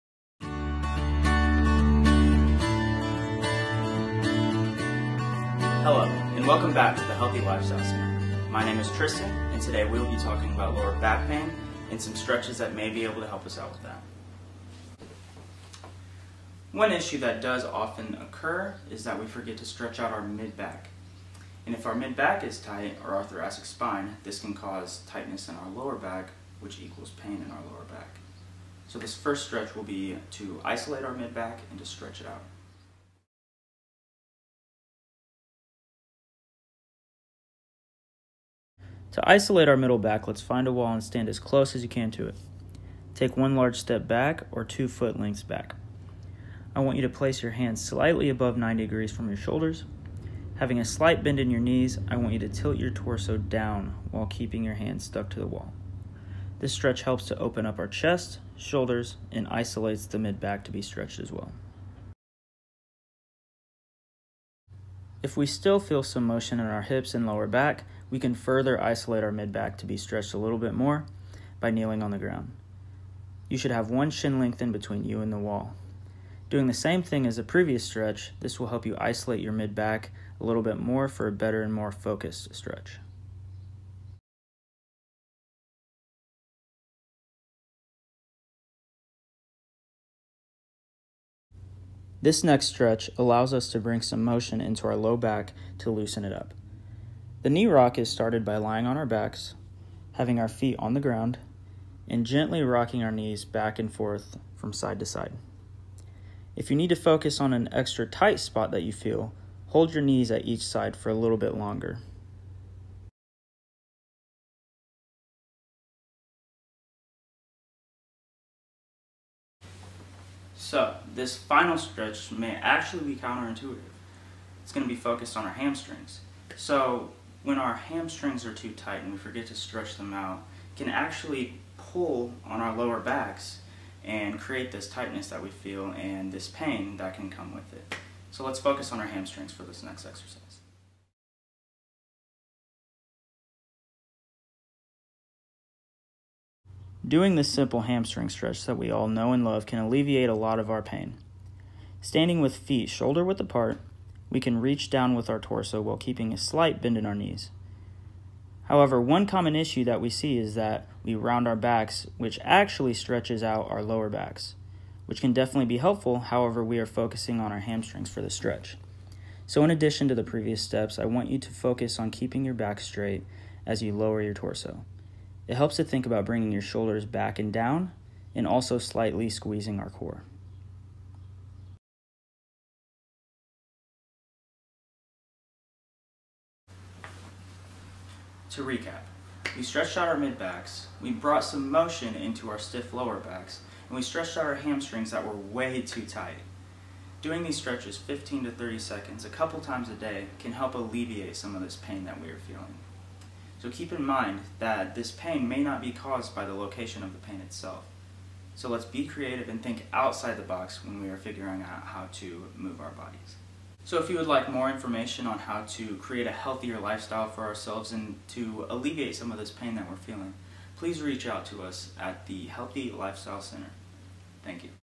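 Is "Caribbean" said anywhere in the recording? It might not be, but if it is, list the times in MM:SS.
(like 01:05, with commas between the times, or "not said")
not said.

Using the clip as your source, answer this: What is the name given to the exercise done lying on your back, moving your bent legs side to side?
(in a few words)
Knee rock.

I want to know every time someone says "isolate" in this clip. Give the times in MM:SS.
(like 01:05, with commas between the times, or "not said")
00:30, 00:39, 00:59, 01:08, 01:18.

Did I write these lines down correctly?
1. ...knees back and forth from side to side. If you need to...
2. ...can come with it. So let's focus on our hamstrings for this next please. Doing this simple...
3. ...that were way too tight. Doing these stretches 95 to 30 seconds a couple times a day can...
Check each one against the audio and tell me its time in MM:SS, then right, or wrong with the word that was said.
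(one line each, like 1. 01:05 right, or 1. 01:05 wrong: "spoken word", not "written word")
1. 01:43 right
2. 02:17 wrong: "exercise", not "please"
3. 03:15 wrong: "15", not "95".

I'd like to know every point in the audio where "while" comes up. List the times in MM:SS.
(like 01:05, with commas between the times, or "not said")
00:54, 02:35.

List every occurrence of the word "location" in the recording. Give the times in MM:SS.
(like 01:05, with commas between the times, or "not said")
03:26.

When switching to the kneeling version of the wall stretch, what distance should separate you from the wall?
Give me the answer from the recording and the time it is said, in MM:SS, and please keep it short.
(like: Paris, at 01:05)
1 shin length, at 01:13.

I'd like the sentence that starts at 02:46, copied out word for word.
However, we are focusing on our hamstrings for the stretch.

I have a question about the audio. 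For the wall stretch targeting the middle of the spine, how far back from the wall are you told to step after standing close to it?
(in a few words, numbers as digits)
2 foot lengths.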